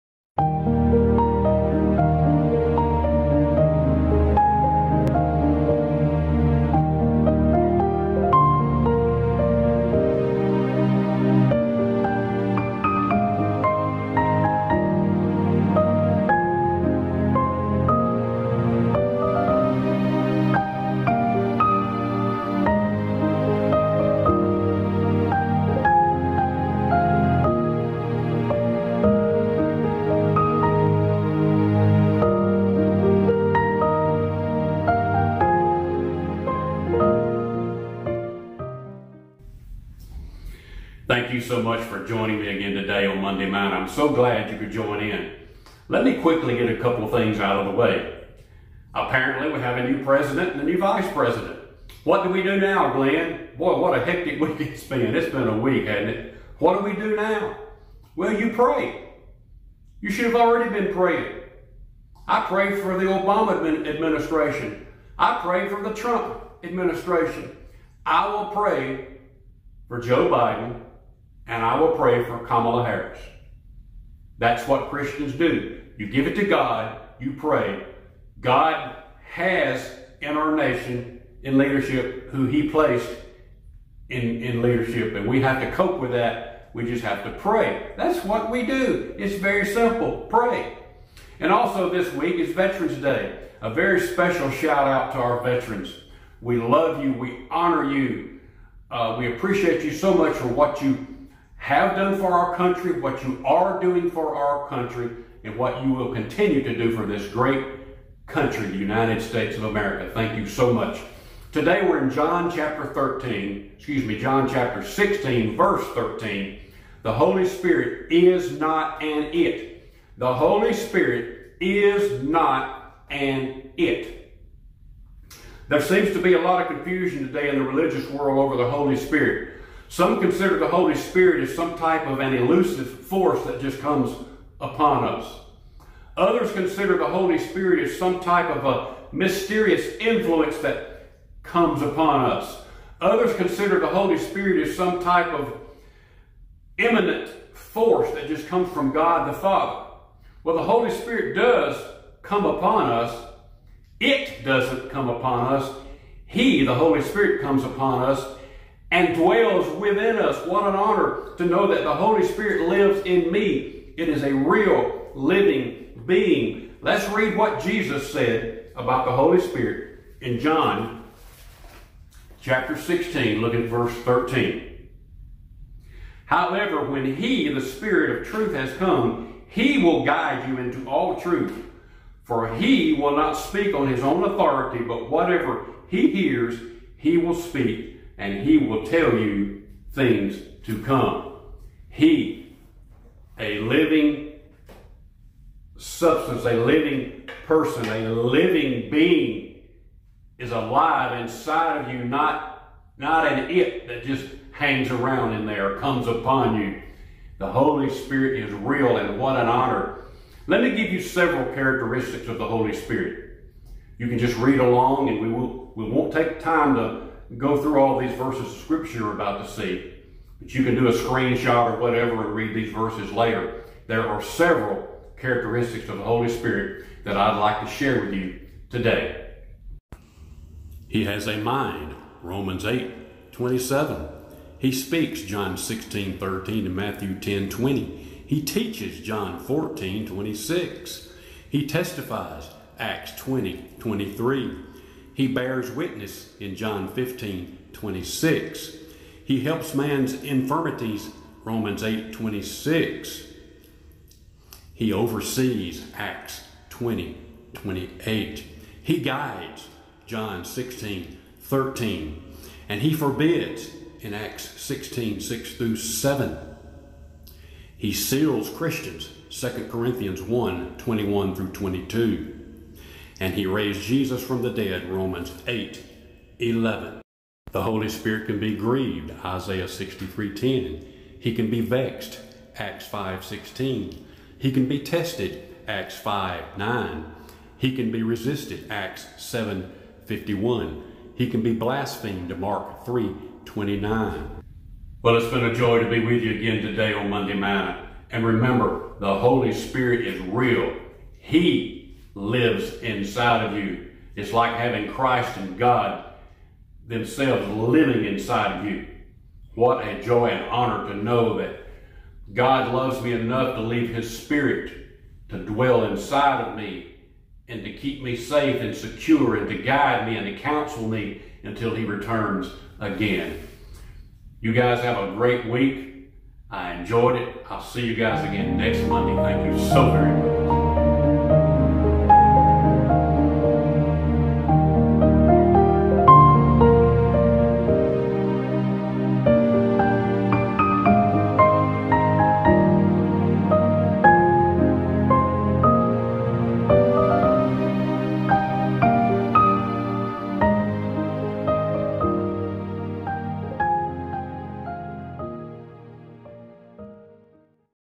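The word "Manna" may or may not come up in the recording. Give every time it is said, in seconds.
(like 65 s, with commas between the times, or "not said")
43 s, 297 s.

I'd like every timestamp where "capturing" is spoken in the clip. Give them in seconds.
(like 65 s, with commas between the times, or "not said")
not said.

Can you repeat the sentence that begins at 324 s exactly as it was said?
You guys have a great week.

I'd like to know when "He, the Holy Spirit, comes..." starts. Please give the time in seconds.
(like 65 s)
156 s.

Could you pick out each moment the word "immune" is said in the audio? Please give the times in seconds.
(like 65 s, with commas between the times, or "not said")
not said.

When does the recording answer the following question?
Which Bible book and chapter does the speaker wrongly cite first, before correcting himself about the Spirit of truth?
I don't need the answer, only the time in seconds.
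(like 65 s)
112 s.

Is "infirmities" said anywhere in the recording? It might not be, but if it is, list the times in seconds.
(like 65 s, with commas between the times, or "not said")
250 s.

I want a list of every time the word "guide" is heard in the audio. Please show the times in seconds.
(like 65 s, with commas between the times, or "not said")
180 s, 258 s, 319 s.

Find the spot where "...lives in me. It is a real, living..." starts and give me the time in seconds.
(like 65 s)
162 s.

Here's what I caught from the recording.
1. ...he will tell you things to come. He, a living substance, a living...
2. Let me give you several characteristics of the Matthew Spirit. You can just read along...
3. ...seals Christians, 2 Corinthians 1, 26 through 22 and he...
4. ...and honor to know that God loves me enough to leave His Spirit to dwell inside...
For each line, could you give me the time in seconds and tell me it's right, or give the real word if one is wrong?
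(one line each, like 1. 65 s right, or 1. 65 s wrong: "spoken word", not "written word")
1. 188 s right
2. 210 s wrong: "Holy", not "Matthew"
3. 267 s wrong: "21", not "26"
4. 310 s right.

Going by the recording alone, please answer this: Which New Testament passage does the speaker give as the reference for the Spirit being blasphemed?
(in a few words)
Mark 3:29.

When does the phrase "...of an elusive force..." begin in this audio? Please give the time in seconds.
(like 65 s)
132 s.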